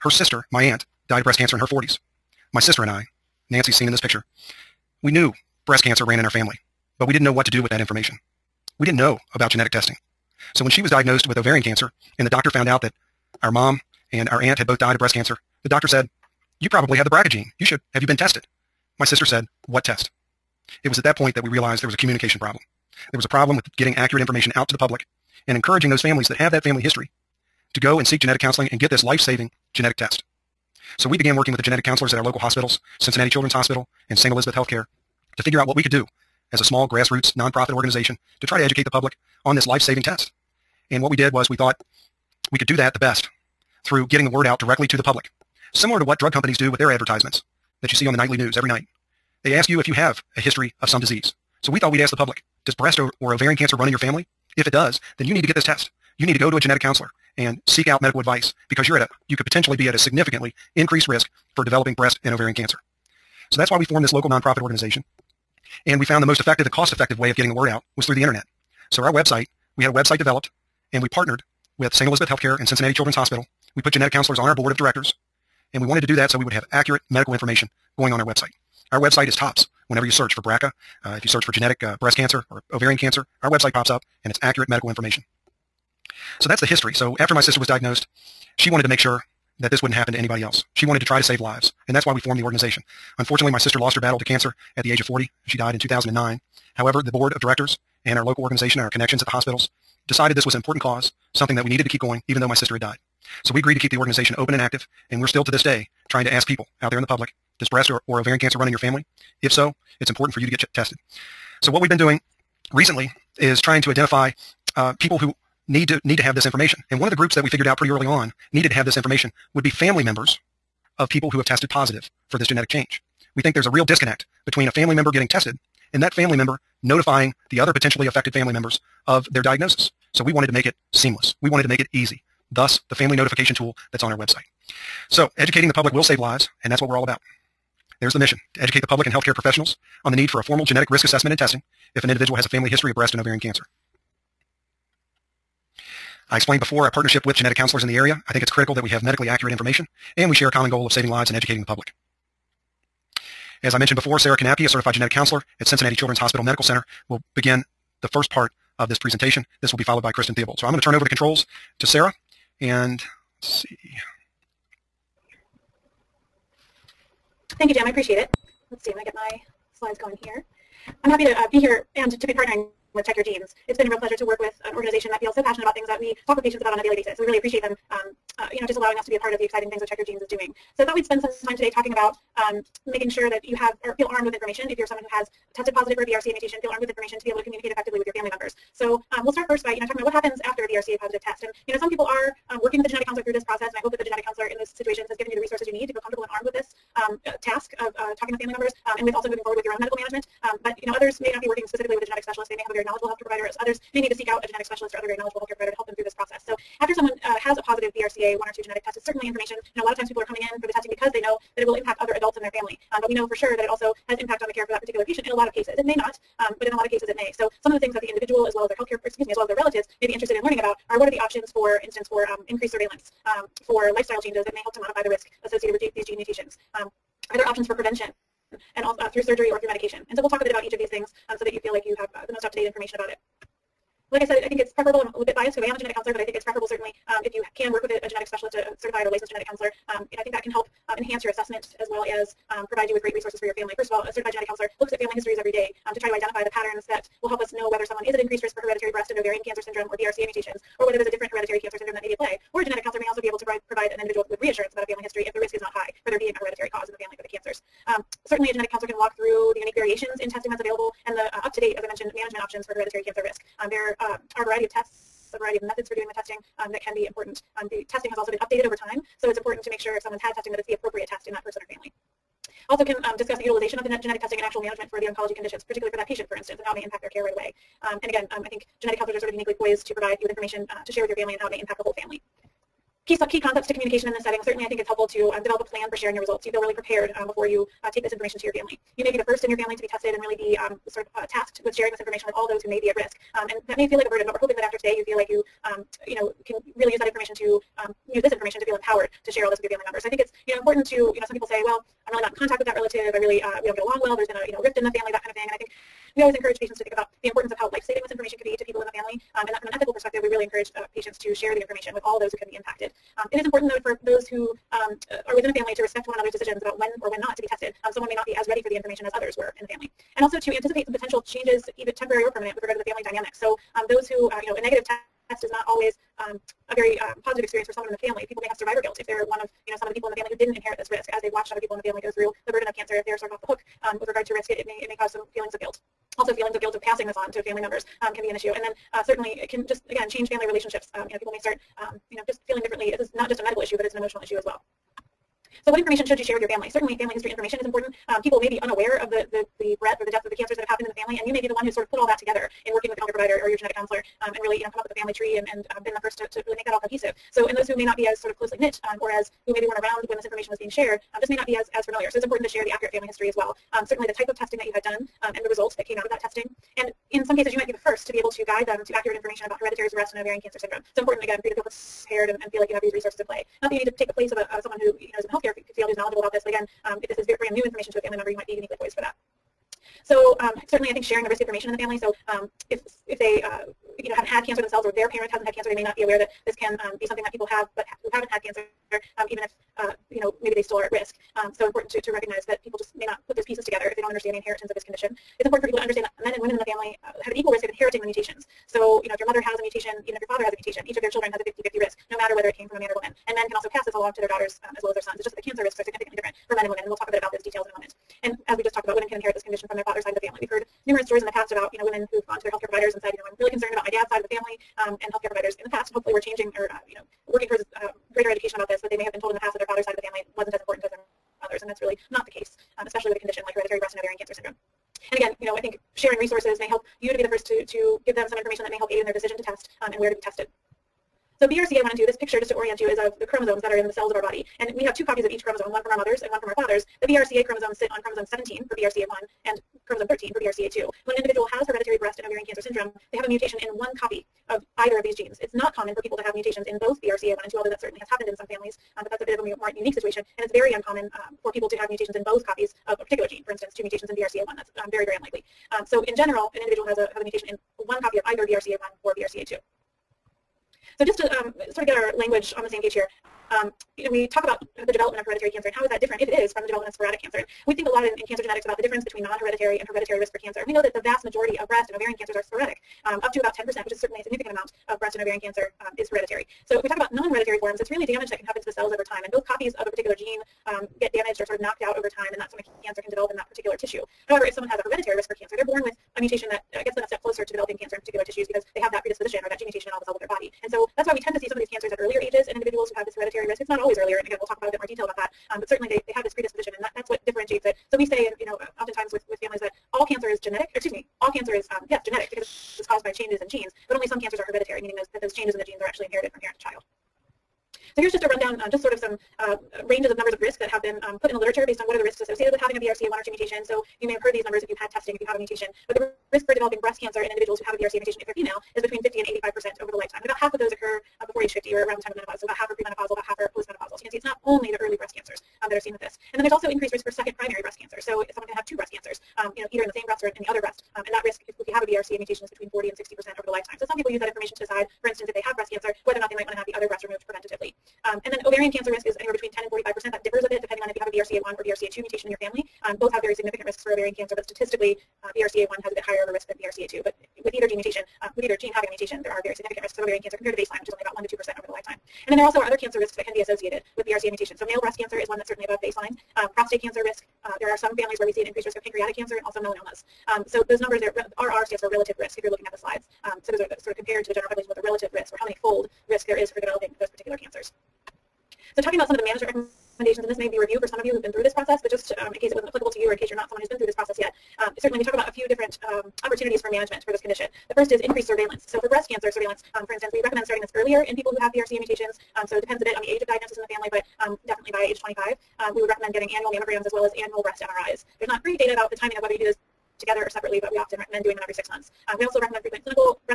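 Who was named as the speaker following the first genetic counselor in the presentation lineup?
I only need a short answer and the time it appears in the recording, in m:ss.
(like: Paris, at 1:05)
Kristin Theobald, at 2:40.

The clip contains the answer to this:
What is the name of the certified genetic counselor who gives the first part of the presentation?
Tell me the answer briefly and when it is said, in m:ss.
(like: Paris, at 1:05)
Sara Knapke, at 2:34.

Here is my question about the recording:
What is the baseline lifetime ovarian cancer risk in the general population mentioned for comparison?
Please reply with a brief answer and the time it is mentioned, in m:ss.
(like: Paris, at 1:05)
1 to 2%, at 9:11.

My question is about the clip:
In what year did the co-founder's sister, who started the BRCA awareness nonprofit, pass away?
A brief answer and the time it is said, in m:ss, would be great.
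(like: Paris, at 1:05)
2009, at 1:35.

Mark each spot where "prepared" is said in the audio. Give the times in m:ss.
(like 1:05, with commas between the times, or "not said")
4:46, 6:11.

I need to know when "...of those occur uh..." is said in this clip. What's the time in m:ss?
8:40.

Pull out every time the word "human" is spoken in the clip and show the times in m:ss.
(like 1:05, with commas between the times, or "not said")
not said.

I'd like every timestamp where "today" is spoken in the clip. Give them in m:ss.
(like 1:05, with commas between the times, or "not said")
3:01, 4:54.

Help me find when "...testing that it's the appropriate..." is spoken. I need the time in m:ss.
4:30.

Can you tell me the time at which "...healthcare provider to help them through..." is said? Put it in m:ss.
3:25.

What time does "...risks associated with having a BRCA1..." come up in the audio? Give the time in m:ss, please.
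8:32.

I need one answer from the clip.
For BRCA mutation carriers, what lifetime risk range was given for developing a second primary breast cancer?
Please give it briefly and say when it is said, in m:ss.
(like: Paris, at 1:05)
40 to 60 percent, at 8:52.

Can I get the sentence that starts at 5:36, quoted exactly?
Also feelings of guilt of passing this on to family members um, can be an issue.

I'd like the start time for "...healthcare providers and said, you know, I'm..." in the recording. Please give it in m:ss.
6:52.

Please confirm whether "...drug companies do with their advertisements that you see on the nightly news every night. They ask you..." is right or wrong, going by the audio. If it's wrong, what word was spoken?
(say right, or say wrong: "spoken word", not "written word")
right.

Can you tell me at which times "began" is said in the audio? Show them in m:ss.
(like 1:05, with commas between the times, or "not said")
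0:31.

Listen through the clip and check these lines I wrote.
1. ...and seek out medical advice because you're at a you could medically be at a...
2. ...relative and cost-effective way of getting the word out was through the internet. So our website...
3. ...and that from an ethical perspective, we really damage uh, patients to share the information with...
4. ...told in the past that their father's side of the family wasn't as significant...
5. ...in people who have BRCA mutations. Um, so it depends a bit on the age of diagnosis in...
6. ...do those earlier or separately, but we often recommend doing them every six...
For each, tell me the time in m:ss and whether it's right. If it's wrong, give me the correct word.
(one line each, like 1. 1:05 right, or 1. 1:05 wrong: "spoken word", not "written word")
1. 0:57 wrong: "potentially", not "medically"
2. 1:06 wrong: "effective", not "relative"
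3. 5:09 wrong: "encourage", not "damage"
4. 6:59 wrong: "important", not "significant"
5. 9:41 right
6. 9:49 wrong: "together", not "earlier".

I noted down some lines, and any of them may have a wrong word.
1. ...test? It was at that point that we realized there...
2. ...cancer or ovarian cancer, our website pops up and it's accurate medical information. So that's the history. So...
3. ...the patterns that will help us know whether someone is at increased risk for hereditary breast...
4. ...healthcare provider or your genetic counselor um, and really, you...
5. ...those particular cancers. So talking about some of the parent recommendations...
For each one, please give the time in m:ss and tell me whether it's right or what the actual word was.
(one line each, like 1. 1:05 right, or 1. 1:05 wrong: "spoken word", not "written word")
1. 0:19 right
2. 1:22 right
3. 4:06 right
4. 5:52 right
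5. 9:27 wrong: "management", not "parent".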